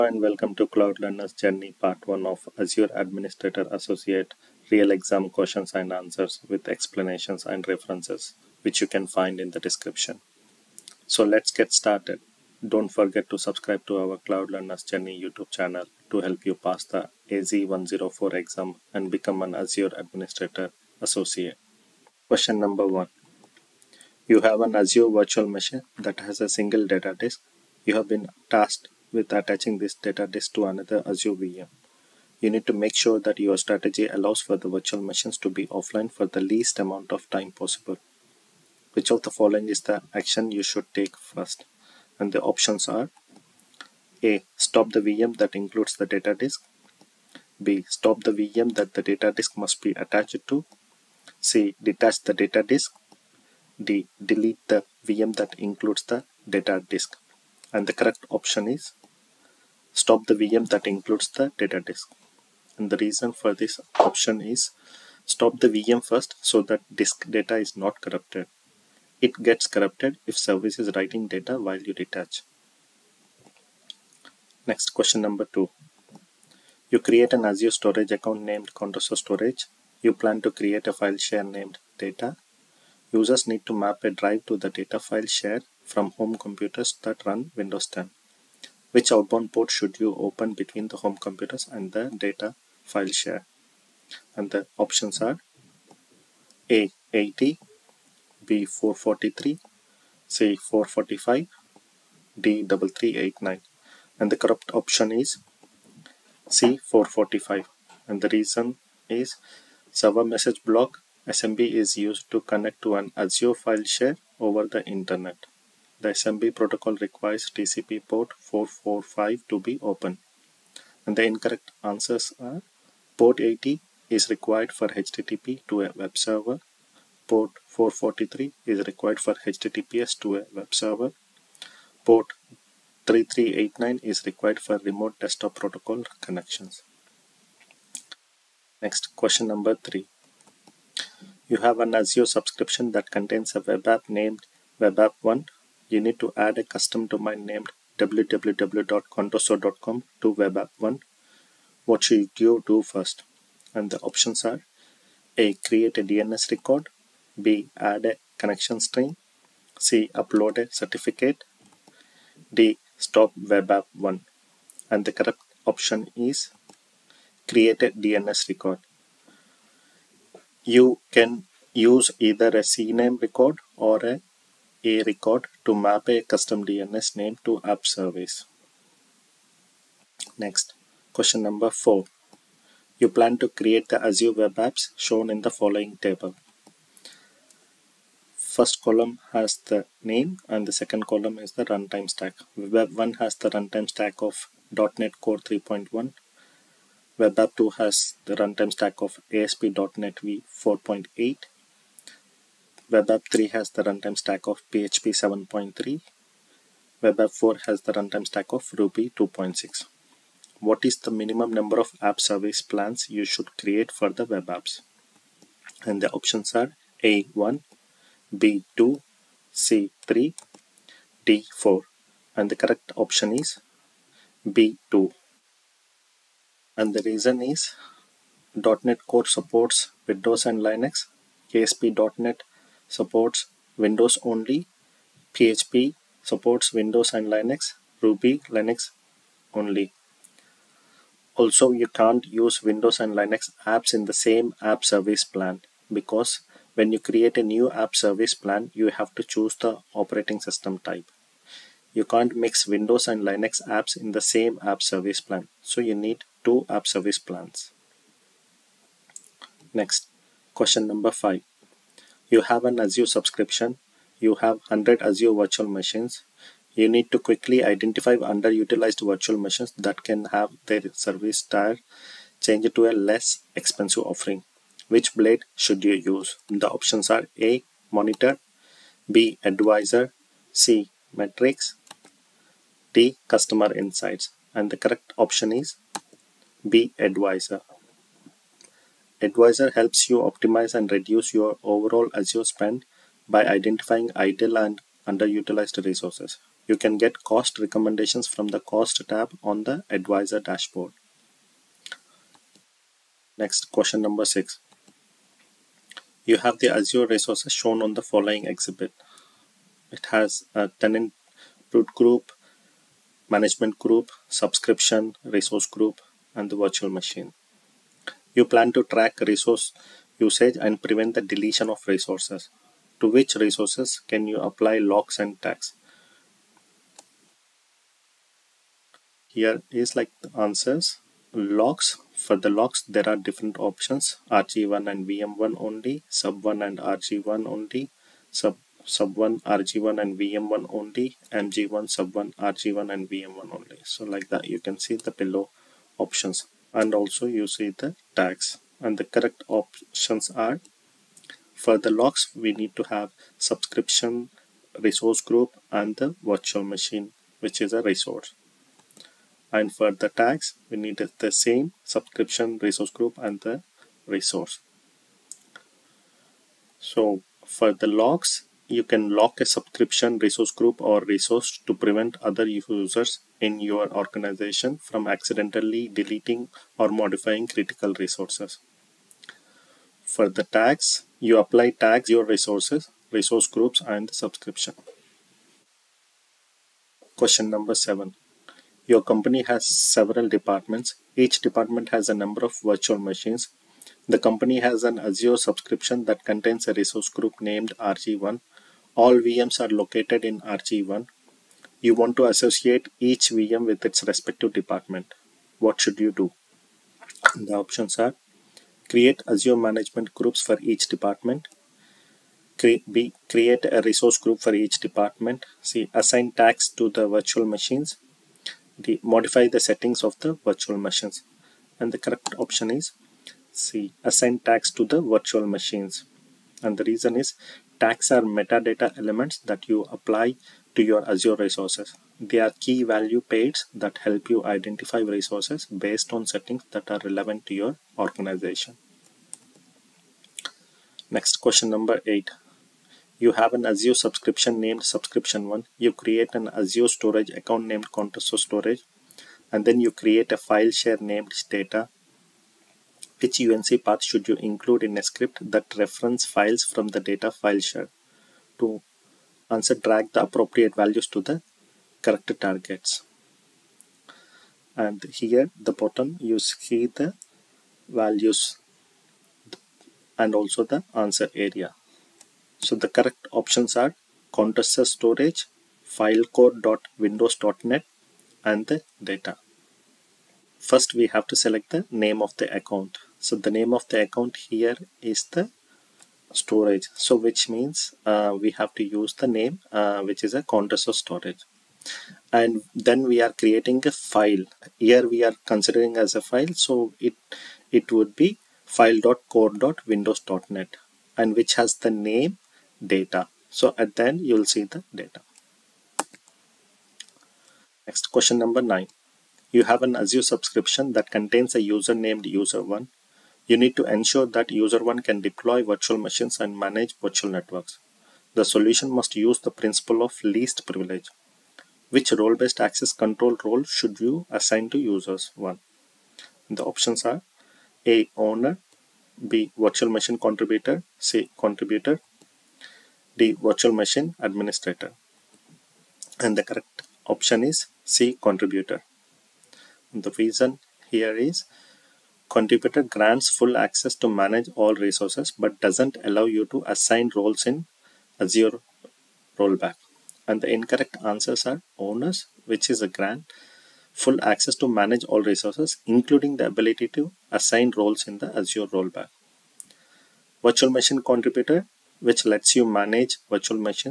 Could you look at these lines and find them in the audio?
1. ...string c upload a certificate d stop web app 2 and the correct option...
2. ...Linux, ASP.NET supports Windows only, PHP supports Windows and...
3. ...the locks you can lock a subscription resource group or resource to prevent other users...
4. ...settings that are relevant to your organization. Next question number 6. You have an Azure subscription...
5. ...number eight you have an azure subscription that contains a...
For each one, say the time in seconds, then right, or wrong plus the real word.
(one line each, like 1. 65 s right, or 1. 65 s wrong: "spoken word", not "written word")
1. 158 s wrong: "1", not "2"
2. 230 s right
3. 367 s right
4. 436 s wrong: "8", not "6"
5. 508 s wrong: "nine", not "eight".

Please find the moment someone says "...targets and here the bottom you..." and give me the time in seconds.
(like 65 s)
462 s.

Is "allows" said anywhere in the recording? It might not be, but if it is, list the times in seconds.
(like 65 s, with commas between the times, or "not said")
34 s, 546 s.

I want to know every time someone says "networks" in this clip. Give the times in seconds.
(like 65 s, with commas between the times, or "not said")
517 s.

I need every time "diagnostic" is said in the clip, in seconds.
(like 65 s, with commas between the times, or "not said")
not said.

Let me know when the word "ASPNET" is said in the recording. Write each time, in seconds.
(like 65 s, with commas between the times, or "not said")
199 s, 231 s.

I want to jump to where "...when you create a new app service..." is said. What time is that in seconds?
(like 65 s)
246 s.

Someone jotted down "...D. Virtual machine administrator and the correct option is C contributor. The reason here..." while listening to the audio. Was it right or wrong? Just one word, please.
right.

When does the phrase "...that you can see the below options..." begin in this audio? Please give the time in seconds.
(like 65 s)
344 s.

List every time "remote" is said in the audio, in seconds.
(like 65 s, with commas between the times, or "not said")
134 s.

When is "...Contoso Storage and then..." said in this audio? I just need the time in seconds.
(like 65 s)
447 s.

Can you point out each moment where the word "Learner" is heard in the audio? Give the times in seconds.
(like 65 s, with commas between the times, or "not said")
0 s, 14 s.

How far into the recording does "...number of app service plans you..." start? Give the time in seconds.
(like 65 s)
211 s.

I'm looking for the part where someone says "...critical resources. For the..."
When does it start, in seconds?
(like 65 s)
377 s.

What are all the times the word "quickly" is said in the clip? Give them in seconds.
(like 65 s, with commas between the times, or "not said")
267 s.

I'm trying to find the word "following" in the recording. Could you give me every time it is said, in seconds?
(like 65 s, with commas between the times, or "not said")
39 s, 185 s, 308 s.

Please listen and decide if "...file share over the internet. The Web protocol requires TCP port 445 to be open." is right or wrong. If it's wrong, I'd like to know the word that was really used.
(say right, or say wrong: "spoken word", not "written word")
wrong: "SMB", not "Web".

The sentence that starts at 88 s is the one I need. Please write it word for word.
Which outbound port should you open between the home computers and the data file share?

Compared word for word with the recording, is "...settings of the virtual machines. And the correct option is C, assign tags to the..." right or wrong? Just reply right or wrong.
right.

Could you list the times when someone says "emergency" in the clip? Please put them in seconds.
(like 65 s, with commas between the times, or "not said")
not said.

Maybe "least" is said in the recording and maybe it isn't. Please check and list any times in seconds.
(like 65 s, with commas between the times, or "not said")
36 s, 520 s.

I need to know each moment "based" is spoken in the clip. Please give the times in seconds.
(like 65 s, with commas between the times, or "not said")
435 s, 522 s.